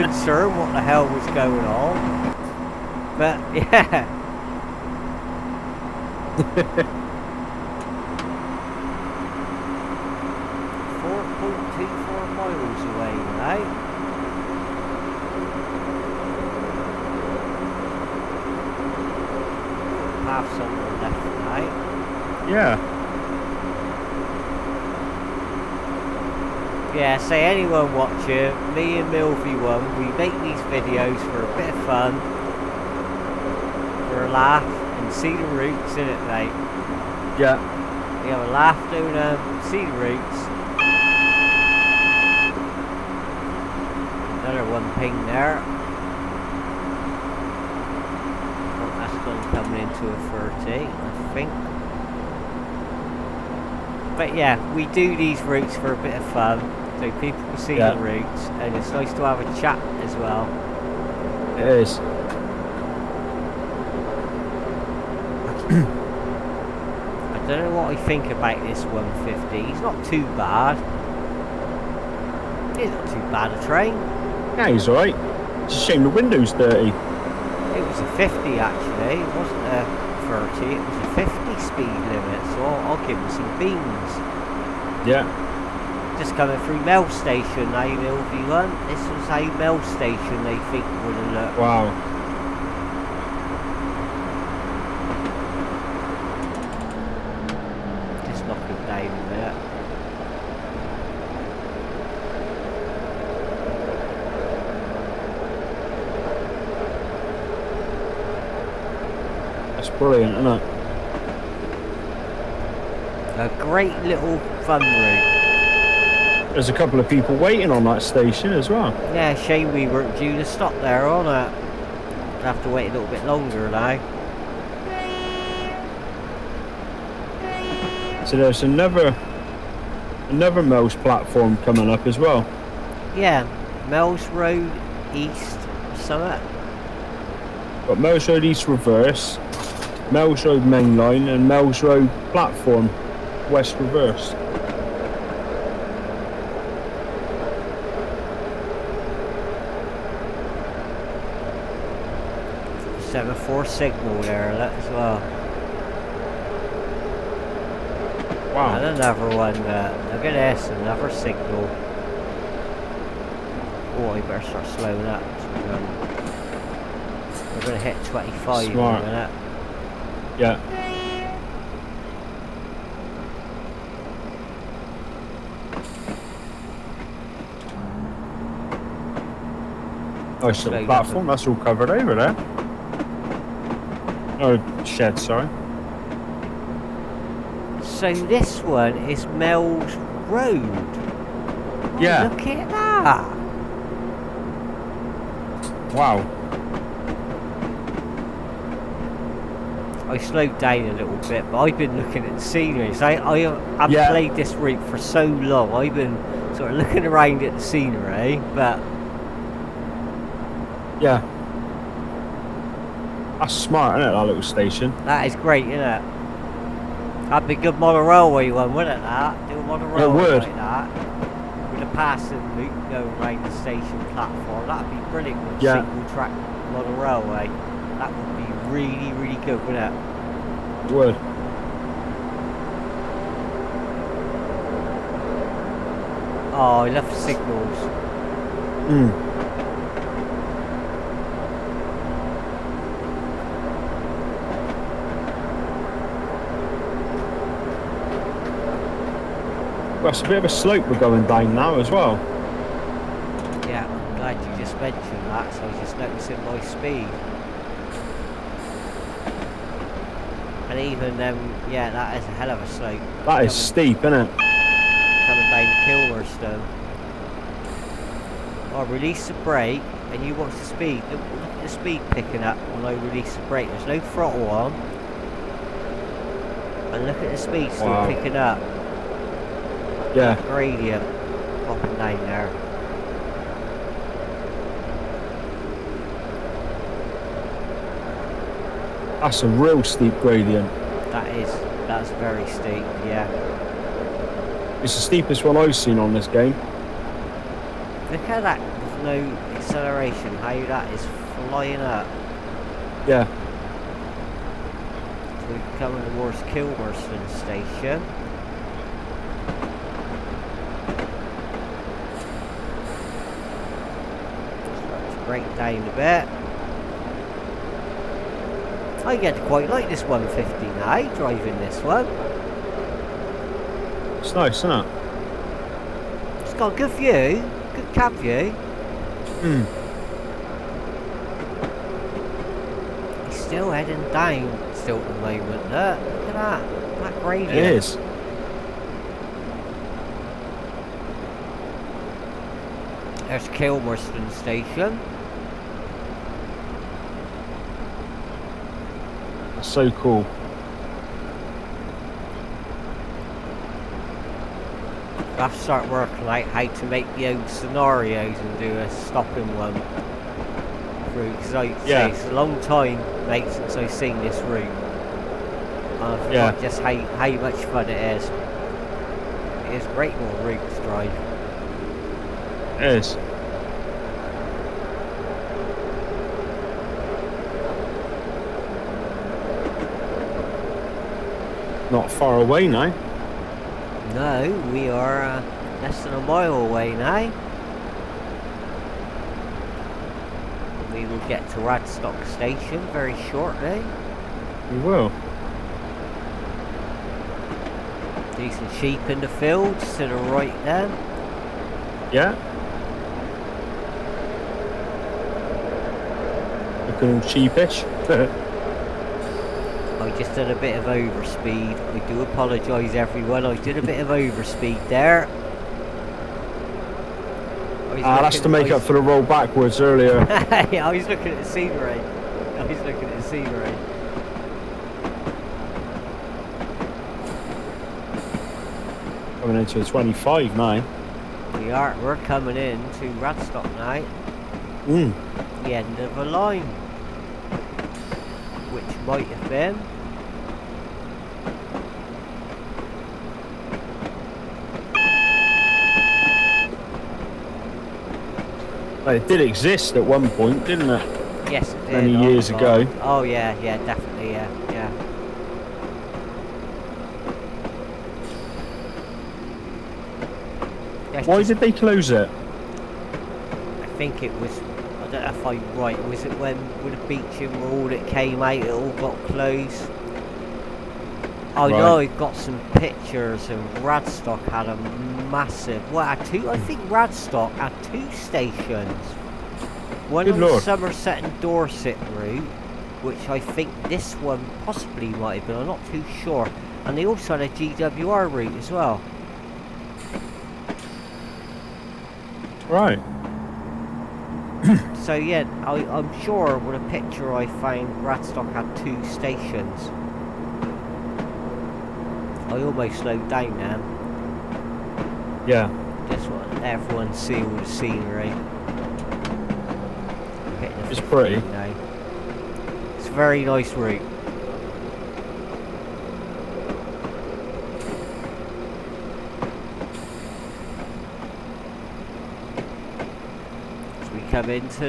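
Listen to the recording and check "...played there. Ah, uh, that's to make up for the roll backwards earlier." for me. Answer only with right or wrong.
wrong.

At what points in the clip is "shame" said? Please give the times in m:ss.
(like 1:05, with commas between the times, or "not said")
1:15, 1:59.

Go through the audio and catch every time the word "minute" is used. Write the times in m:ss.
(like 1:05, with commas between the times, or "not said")
2:49.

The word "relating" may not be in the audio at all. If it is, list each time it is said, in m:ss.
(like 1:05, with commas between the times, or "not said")
not said.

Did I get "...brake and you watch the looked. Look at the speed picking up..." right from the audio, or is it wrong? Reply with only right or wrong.
wrong.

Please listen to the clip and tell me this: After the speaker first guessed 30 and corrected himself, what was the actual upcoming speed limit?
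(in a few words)
50.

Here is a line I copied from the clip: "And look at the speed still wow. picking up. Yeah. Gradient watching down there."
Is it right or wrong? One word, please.
wrong.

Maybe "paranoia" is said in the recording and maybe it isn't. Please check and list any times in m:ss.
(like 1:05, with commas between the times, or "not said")
not said.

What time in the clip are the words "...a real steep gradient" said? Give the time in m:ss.
4:49.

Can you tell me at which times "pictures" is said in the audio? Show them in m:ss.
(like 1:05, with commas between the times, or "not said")
7:52, 8:16.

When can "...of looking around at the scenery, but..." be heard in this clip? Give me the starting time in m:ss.
3:26.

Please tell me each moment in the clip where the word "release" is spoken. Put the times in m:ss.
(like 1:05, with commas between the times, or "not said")
4:28, 4:33.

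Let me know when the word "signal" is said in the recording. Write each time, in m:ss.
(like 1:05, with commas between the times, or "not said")
2:33, 2:41, 3:57.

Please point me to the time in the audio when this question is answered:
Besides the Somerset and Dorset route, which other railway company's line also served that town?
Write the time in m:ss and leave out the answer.
8:07.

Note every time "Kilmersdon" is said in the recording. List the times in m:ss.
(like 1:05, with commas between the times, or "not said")
5:06, 5:43.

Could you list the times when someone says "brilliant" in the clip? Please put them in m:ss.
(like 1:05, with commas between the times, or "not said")
1:50, 3:45.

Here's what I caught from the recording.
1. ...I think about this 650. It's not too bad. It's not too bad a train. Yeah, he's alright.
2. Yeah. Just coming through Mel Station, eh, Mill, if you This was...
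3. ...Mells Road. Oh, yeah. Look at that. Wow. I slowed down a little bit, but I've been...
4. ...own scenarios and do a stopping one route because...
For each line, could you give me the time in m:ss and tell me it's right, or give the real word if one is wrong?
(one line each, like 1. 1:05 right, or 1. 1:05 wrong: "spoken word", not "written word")
1. 1:07 wrong: "150", not "650"
2. 1:25 right
3. 3:09 right
4. 5:57 right.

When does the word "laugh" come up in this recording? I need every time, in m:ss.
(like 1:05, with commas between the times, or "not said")
0:34, 0:38.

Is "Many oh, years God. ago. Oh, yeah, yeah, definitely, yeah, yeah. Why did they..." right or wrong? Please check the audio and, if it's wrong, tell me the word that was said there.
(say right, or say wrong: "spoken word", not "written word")
right.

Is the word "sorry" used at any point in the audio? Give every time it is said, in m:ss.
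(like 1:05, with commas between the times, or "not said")
3:05.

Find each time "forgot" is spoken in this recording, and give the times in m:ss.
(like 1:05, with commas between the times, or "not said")
6:06.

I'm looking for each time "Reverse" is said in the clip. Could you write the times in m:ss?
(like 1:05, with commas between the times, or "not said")
2:18, 2:23.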